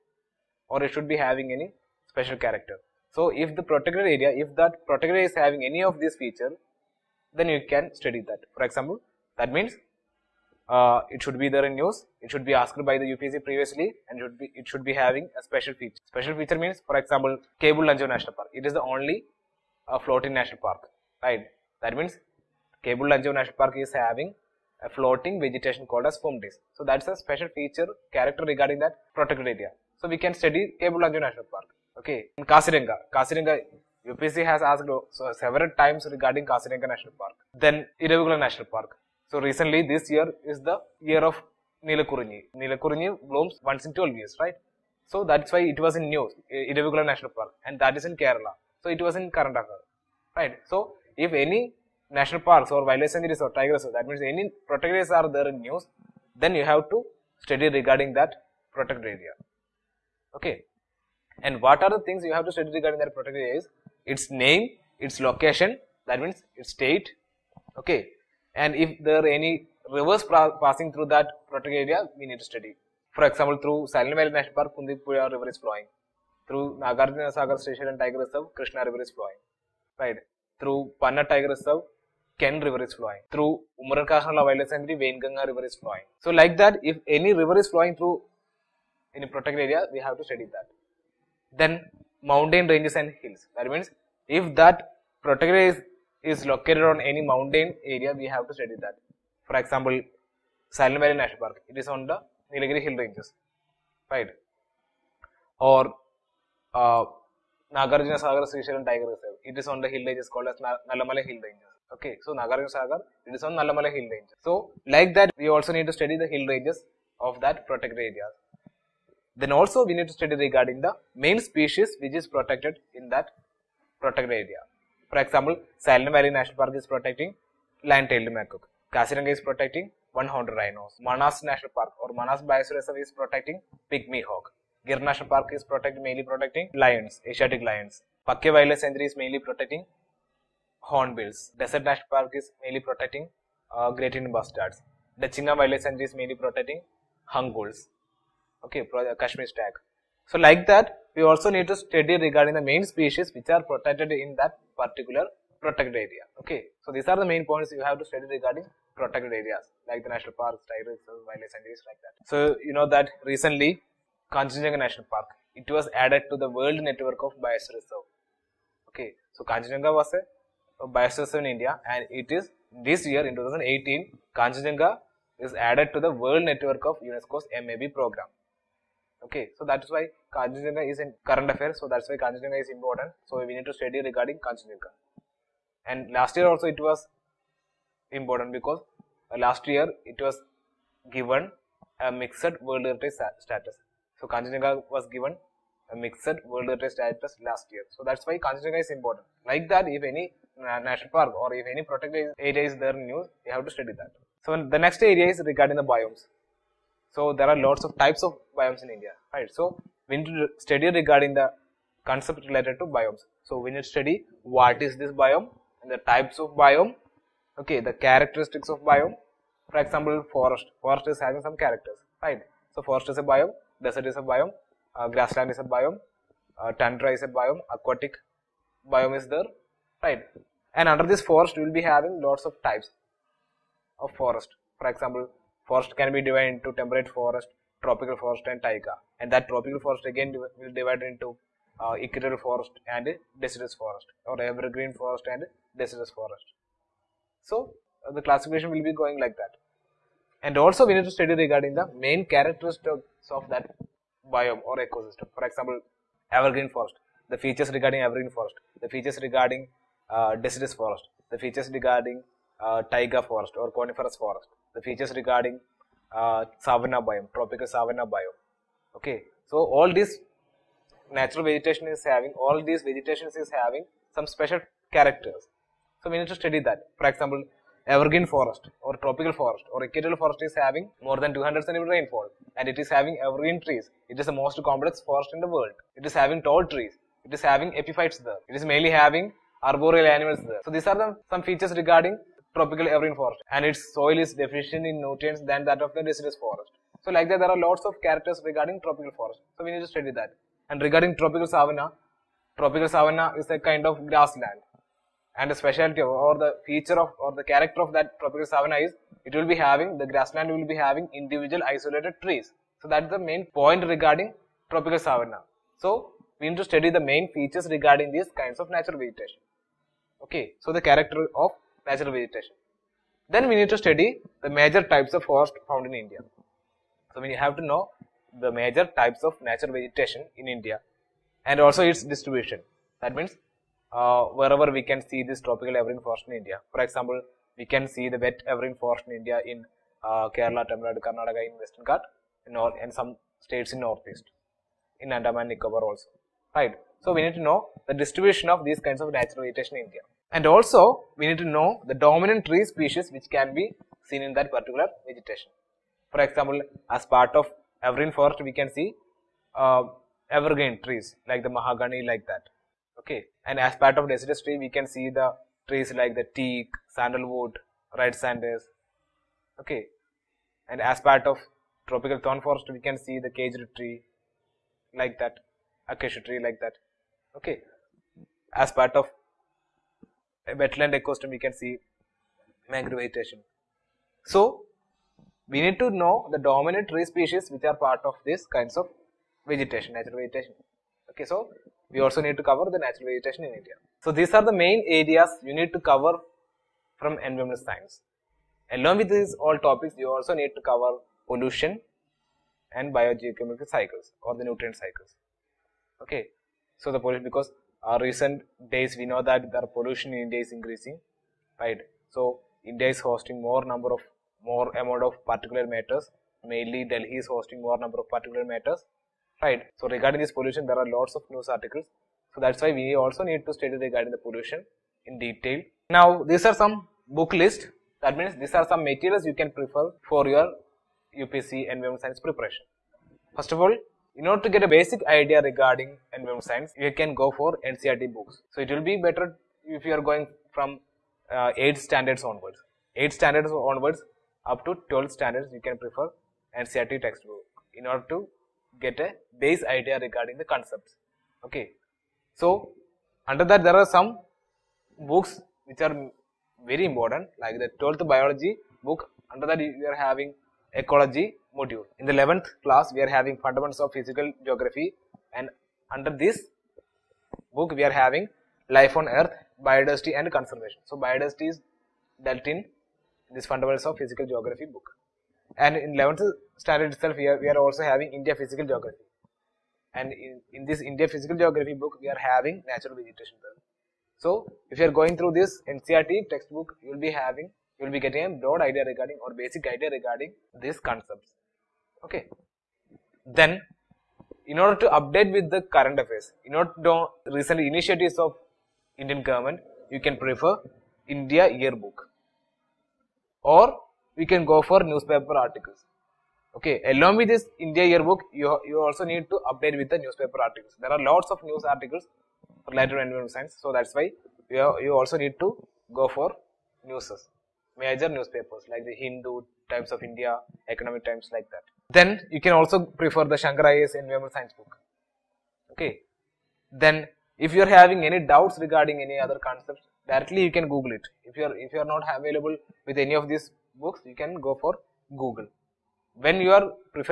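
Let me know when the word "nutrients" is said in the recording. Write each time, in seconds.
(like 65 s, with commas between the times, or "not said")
294 s, 404 s.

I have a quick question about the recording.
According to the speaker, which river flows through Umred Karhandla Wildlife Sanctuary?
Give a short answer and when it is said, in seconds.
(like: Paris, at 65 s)
Vainganga River, at 85 s.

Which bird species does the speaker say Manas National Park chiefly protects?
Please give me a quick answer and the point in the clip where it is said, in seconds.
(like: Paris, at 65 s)
pygmy hawk, at 133 s.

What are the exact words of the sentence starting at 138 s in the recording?
pakke Wildlife Sanctuary is mainly protecting hornbills.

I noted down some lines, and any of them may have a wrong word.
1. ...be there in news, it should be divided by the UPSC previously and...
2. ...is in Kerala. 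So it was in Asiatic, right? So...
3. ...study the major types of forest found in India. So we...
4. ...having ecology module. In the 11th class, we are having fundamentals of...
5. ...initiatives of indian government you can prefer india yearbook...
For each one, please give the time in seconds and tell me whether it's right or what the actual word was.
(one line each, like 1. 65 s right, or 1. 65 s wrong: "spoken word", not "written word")
1. 11 s wrong: "asked", not "divided"
2. 47 s wrong: "Kerala", not "Asiatic"
3. 323 s right
4. 459 s right
5. 497 s right.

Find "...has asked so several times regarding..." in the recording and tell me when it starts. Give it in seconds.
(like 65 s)
34 s.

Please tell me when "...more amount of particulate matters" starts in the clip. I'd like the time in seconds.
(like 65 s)
414 s.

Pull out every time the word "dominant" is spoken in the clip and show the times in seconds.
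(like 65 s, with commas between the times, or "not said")
351 s, 386 s.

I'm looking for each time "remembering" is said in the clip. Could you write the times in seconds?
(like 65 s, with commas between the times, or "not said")
not said.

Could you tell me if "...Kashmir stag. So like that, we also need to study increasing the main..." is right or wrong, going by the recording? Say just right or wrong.
wrong.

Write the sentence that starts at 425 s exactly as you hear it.
Now these are some book list.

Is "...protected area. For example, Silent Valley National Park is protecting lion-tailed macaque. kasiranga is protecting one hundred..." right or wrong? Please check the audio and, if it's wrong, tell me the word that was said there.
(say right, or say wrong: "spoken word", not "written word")
right.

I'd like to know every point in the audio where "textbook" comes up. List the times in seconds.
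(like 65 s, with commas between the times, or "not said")
447 s, 486 s.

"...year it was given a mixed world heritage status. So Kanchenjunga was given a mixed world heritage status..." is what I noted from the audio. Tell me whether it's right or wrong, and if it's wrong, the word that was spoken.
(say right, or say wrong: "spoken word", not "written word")
right.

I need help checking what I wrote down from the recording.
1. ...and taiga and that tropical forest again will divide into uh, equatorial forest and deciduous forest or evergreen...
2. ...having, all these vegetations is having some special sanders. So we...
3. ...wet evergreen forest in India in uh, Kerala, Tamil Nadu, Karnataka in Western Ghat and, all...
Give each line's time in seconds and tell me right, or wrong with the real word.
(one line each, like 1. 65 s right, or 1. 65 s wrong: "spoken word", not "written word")
1. 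238 s right
2. 272 s wrong: "characters", not "sanders"
3. 338 s right.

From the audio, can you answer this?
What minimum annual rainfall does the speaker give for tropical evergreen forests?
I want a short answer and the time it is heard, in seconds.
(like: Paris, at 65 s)
200 centimeters, at 281 s.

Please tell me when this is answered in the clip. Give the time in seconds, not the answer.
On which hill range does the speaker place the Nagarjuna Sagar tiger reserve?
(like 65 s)
110 s.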